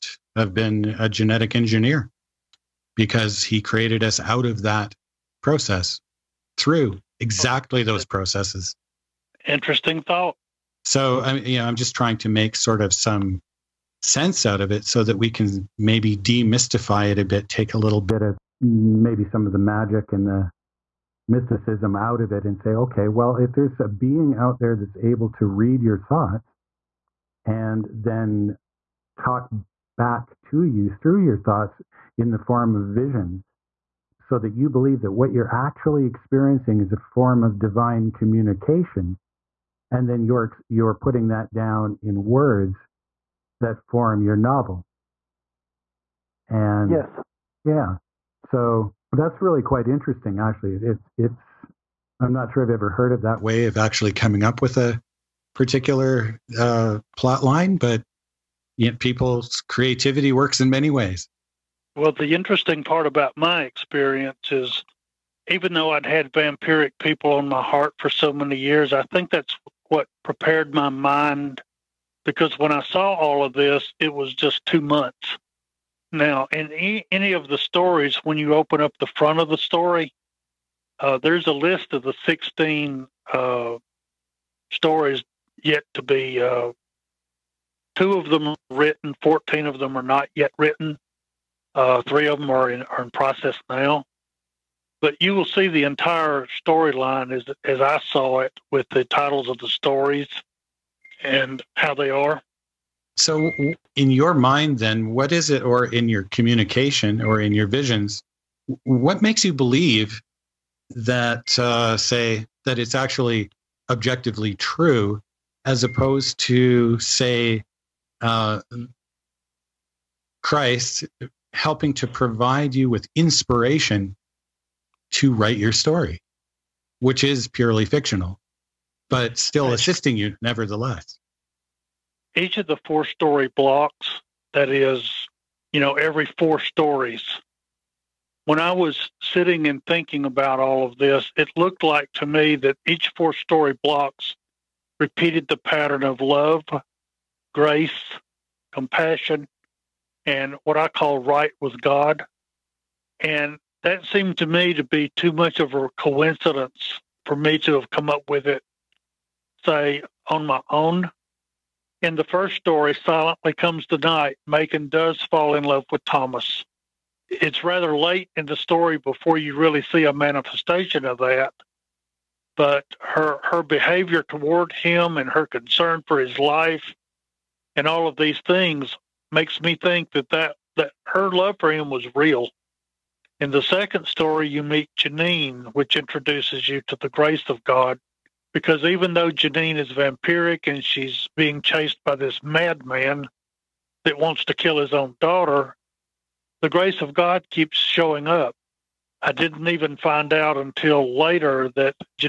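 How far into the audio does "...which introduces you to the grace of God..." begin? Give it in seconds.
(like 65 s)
185 s.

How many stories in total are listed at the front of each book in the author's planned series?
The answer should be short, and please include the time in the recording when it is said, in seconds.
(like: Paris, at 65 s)
16, at 82 s.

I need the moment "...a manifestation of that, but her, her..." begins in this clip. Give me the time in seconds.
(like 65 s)
170 s.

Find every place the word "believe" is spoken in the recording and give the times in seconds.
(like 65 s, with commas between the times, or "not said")
34 s, 109 s.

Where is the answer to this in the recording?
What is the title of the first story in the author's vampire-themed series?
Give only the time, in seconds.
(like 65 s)
162 s.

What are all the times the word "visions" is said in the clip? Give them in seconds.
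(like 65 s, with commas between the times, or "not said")
32 s, 107 s.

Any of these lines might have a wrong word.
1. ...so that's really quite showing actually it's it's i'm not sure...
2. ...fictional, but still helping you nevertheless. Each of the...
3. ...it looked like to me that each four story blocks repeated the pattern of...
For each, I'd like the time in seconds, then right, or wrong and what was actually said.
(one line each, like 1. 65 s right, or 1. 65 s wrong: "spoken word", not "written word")
1. 48 s wrong: "interesting", not "showing"
2. 127 s wrong: "assisting", not "helping"
3. 141 s right.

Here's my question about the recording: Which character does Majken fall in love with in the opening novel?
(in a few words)
Thomas.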